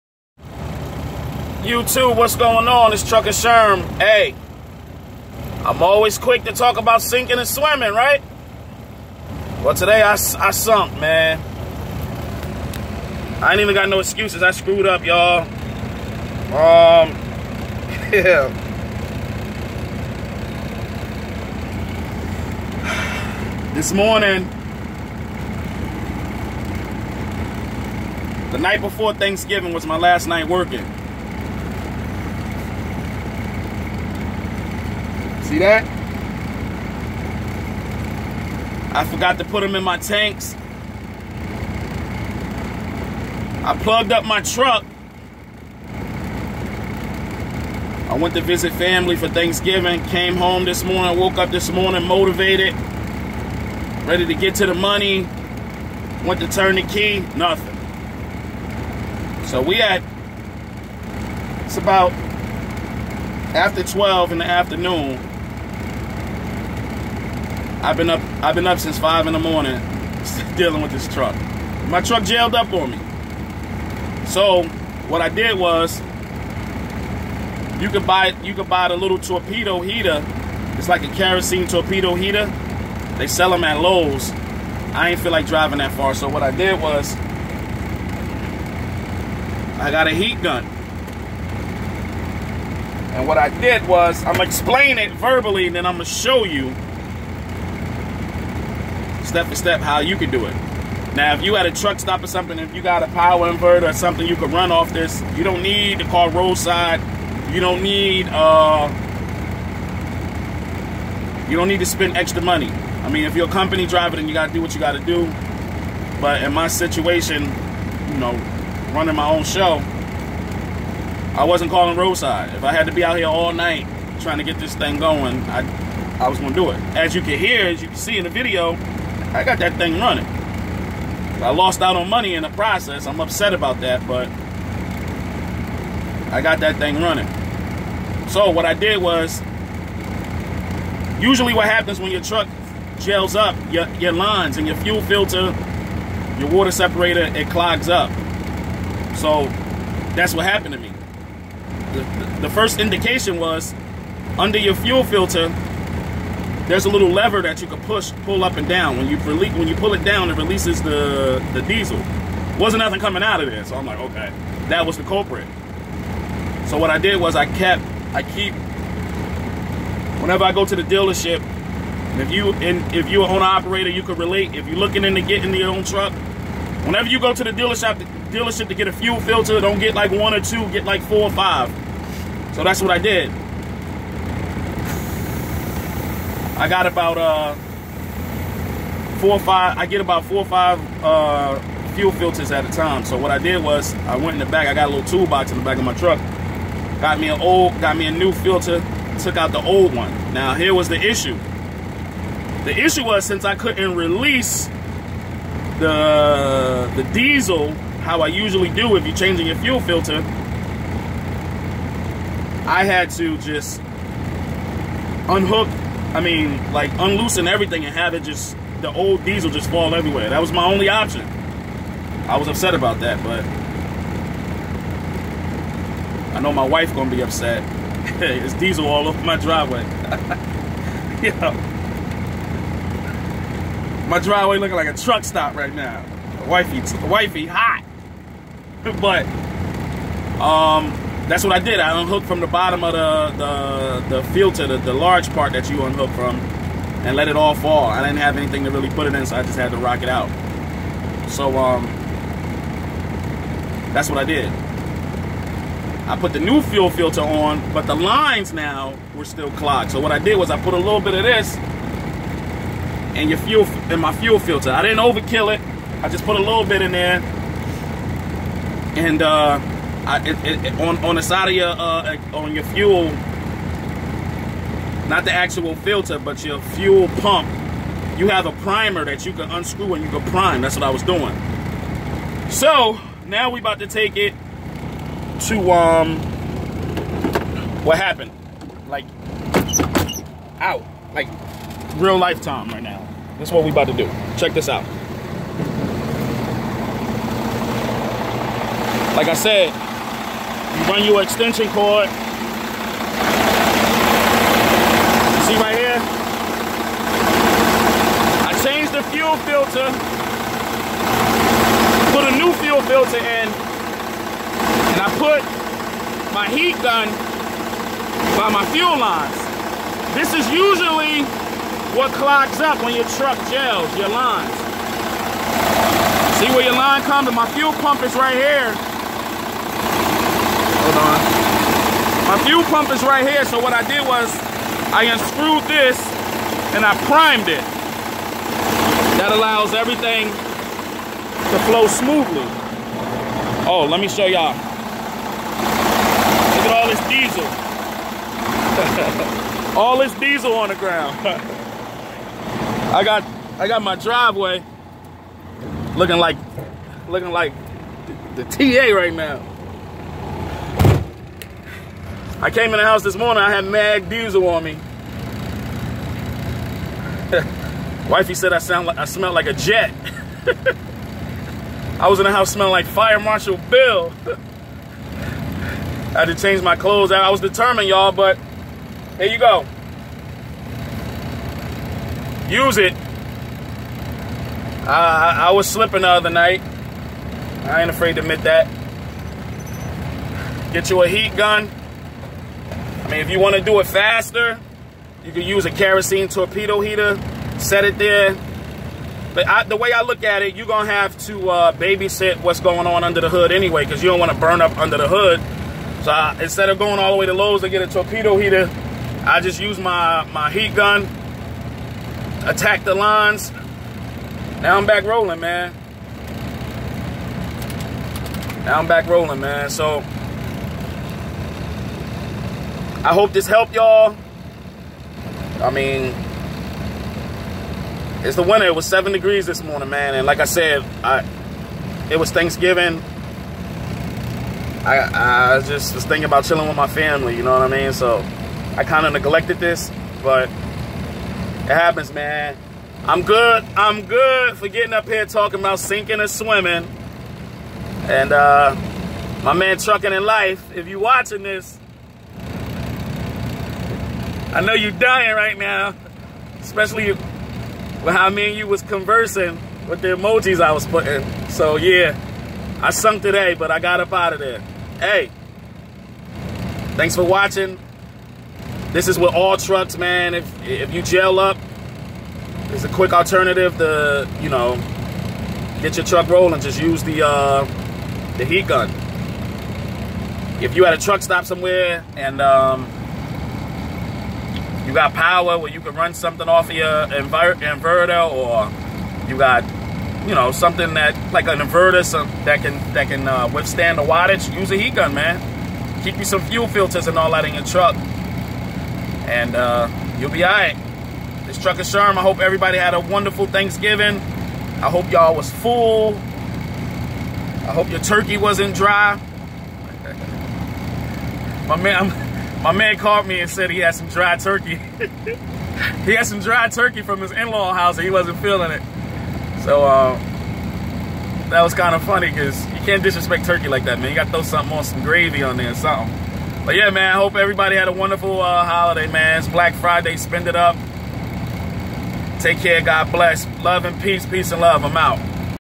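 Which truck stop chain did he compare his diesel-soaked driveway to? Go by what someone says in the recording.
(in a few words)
TA.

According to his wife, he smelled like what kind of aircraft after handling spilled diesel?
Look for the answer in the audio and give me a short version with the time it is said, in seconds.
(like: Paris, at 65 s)
a jet, at 369 s.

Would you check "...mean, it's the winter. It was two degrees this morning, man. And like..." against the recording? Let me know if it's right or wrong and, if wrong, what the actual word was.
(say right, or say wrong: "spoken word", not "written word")
wrong: "seven", not "two".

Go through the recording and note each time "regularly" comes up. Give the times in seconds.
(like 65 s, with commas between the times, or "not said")
not said.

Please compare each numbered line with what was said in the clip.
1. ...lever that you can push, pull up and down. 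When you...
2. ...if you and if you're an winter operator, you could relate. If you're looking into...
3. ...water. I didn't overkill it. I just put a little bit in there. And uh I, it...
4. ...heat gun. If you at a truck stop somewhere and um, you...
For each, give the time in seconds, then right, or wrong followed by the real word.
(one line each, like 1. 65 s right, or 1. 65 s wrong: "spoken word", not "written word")
1. 157 s right
2. 172 s wrong: "owner", not "winter"
3. 264 s wrong: "filter", not "water"
4. 478 s right.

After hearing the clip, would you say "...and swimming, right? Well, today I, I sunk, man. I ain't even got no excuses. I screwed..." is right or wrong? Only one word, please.
right.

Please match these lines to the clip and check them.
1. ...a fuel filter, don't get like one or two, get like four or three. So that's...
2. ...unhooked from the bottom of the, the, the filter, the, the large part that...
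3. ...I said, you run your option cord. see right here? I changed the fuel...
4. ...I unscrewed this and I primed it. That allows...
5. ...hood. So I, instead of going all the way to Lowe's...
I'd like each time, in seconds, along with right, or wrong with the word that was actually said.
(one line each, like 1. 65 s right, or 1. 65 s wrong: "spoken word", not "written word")
1. 178 s wrong: "five", not "three"
2. 242 s right
3. 299 s wrong: "extension", not "option"
4. 334 s right
5. 405 s right.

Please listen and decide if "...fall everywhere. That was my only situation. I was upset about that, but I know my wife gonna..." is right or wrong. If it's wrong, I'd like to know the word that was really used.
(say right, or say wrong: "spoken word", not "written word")
wrong: "option", not "situation".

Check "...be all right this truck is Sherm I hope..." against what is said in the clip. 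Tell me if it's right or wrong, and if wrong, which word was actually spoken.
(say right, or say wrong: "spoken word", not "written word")
right.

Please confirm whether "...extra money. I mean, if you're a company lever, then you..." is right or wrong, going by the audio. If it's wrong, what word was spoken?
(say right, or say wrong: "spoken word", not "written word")
wrong: "driver", not "lever".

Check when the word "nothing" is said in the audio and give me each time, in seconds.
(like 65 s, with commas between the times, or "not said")
57 s, 162 s.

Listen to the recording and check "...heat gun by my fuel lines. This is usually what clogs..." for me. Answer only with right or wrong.
right.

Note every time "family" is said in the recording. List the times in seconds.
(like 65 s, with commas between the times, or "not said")
48 s, 436 s.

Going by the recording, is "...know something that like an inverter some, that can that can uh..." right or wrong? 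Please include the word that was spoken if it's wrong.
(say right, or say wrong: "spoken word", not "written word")
right.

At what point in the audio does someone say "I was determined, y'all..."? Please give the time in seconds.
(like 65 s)
377 s.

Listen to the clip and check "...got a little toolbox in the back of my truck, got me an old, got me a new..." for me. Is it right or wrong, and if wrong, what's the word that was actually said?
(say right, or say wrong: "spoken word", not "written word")
right.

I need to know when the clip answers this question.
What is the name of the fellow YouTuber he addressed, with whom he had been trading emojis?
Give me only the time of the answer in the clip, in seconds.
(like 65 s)
449 s.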